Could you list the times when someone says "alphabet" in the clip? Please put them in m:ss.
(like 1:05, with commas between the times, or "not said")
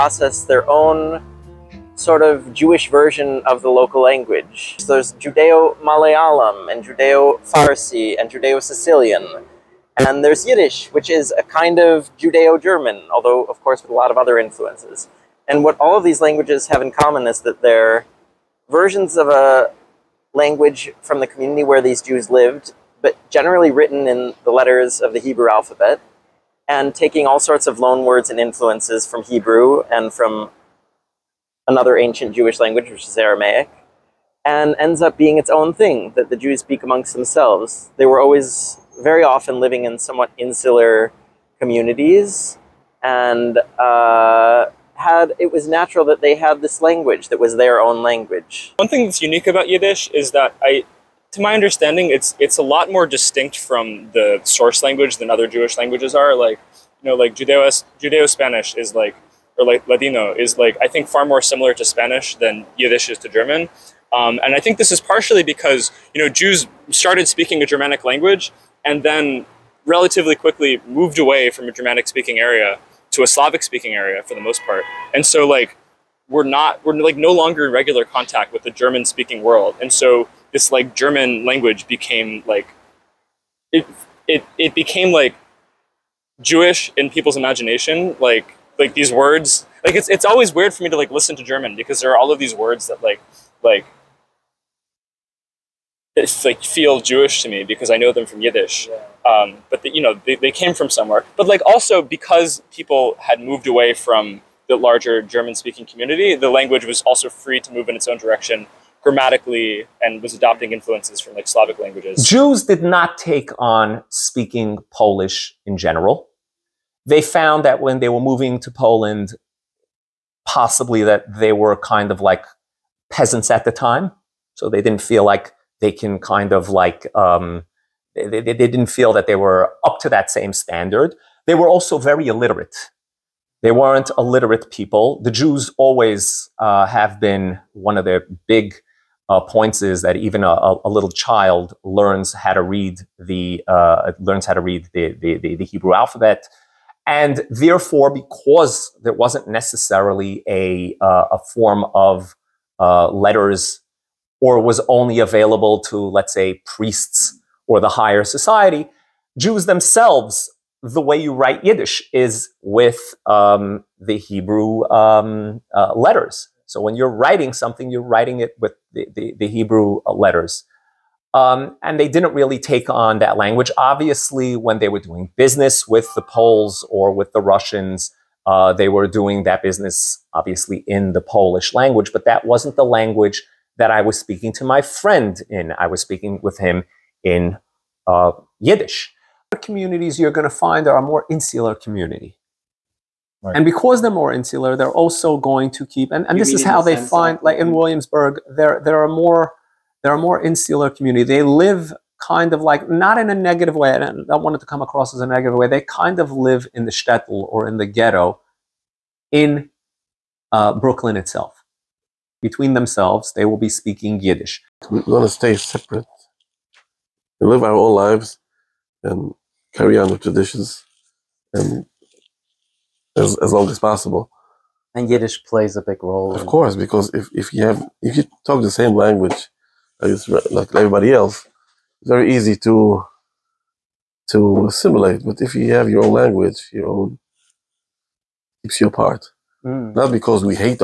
0:25, 2:25.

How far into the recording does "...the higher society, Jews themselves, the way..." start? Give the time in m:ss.
2:37.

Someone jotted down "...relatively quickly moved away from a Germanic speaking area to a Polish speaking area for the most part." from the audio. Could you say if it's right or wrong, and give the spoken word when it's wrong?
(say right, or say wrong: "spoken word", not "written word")
wrong: "Slavic", not "Polish".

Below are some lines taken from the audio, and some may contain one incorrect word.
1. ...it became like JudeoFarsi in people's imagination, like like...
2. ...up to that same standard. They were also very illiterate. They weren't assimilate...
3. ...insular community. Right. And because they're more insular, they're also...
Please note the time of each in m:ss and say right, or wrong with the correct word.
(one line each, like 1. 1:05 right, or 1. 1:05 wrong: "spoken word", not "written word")
1. 1:24 wrong: "Jewish", not "JudeoFarsi"
2. 2:09 wrong: "illiterate", not "assimilate"
3. 3:11 right.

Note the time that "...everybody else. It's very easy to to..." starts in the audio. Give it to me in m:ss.
3:50.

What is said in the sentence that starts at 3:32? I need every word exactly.
Between themselves, they will be speaking Yiddish.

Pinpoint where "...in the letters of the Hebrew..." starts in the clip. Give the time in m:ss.
0:24.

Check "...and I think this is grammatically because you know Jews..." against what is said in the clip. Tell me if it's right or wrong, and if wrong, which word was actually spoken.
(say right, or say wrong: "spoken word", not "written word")
wrong: "partially", not "grammatically".